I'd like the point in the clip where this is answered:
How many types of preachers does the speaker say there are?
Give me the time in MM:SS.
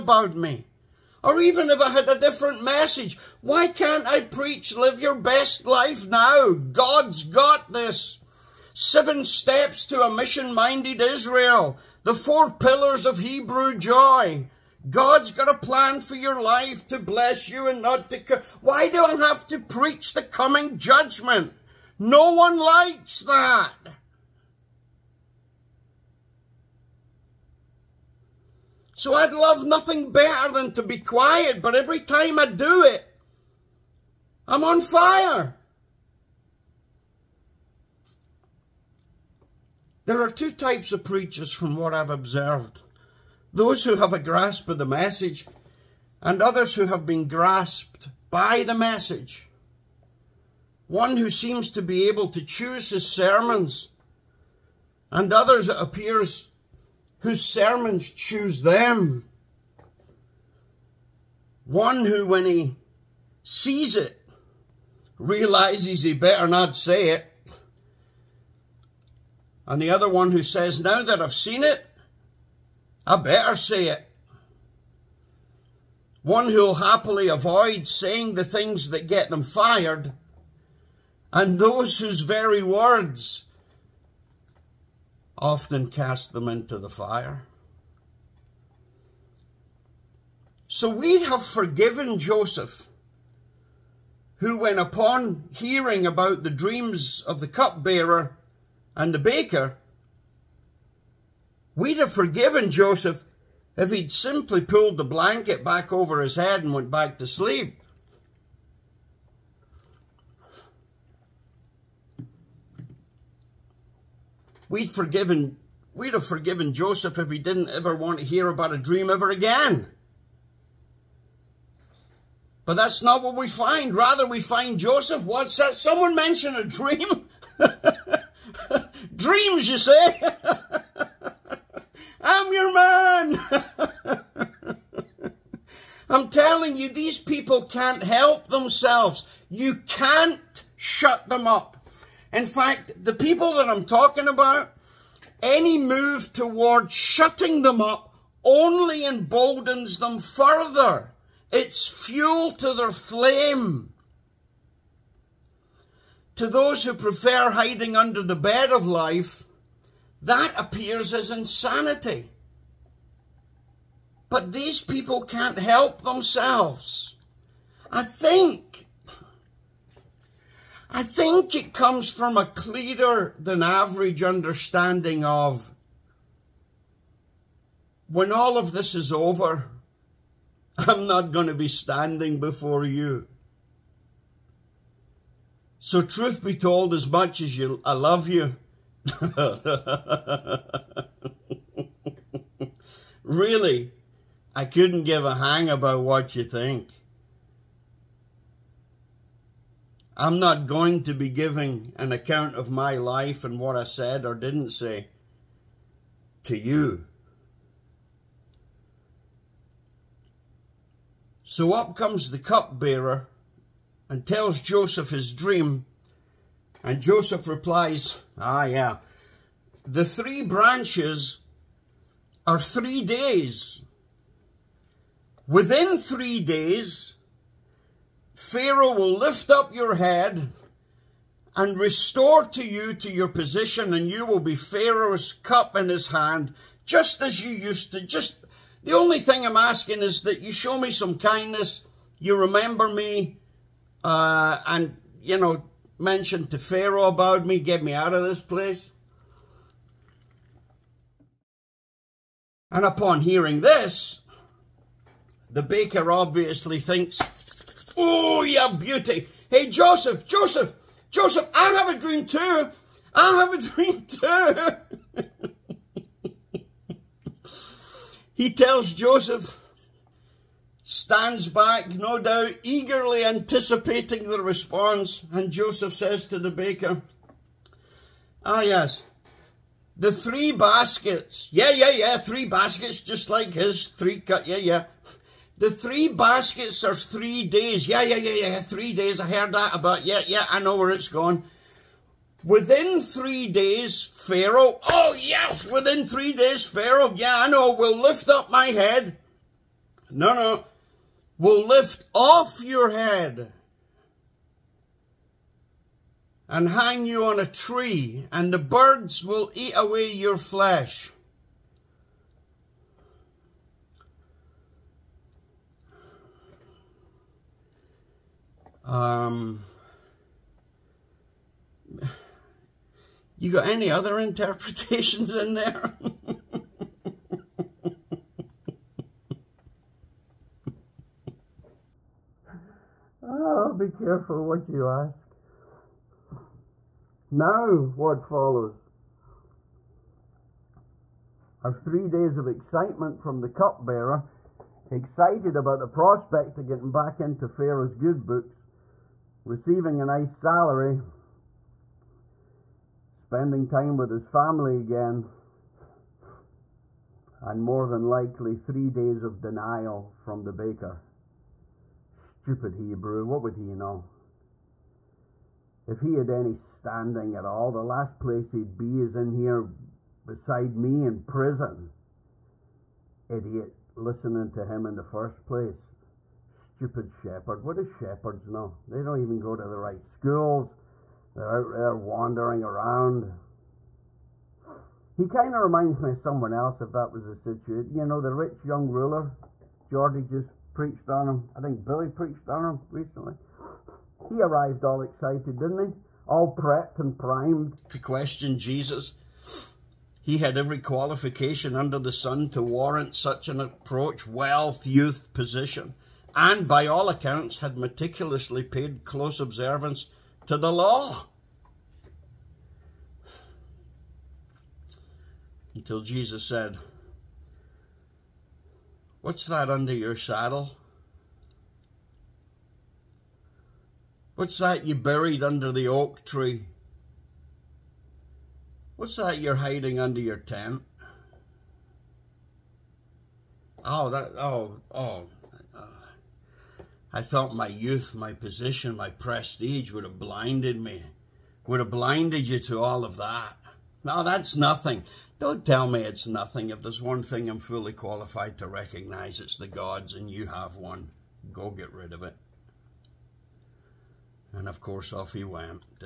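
00:40.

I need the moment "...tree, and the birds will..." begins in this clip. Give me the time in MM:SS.
05:07.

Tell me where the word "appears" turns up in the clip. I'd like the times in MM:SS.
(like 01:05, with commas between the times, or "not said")
00:55, 02:40.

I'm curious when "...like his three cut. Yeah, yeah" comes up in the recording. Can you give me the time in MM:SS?
04:43.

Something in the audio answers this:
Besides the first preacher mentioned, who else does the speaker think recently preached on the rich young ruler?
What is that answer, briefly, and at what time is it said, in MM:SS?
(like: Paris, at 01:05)
Billy, at 06:31.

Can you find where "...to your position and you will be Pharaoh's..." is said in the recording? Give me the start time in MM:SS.
03:52.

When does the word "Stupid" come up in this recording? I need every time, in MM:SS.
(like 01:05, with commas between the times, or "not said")
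06:02, 06:16.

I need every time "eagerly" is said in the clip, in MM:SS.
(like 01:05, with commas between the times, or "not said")
04:32.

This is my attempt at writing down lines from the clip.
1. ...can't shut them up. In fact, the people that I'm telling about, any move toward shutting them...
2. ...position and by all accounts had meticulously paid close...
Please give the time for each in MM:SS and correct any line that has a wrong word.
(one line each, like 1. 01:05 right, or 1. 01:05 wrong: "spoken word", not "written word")
1. 02:19 wrong: "talking", not "telling"
2. 06:45 right.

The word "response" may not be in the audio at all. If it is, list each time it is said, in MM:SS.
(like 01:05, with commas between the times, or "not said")
04:34.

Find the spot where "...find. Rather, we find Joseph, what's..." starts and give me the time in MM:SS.
02:03.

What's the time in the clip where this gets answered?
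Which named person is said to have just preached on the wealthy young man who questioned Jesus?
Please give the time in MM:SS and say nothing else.
06:29.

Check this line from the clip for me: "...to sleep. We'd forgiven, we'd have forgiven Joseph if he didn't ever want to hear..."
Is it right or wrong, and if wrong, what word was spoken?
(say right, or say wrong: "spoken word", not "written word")
right.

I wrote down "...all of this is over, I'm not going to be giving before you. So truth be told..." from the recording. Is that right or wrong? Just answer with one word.
wrong.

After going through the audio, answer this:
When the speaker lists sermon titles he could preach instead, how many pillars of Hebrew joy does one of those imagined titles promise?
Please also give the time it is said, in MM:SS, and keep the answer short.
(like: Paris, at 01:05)
4, at 00:12.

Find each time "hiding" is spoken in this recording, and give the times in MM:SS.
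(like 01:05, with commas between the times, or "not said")
02:37, 07:09.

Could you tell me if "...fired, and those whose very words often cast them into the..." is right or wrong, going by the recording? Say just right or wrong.
right.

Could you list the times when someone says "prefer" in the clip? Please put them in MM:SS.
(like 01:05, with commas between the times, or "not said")
02:36.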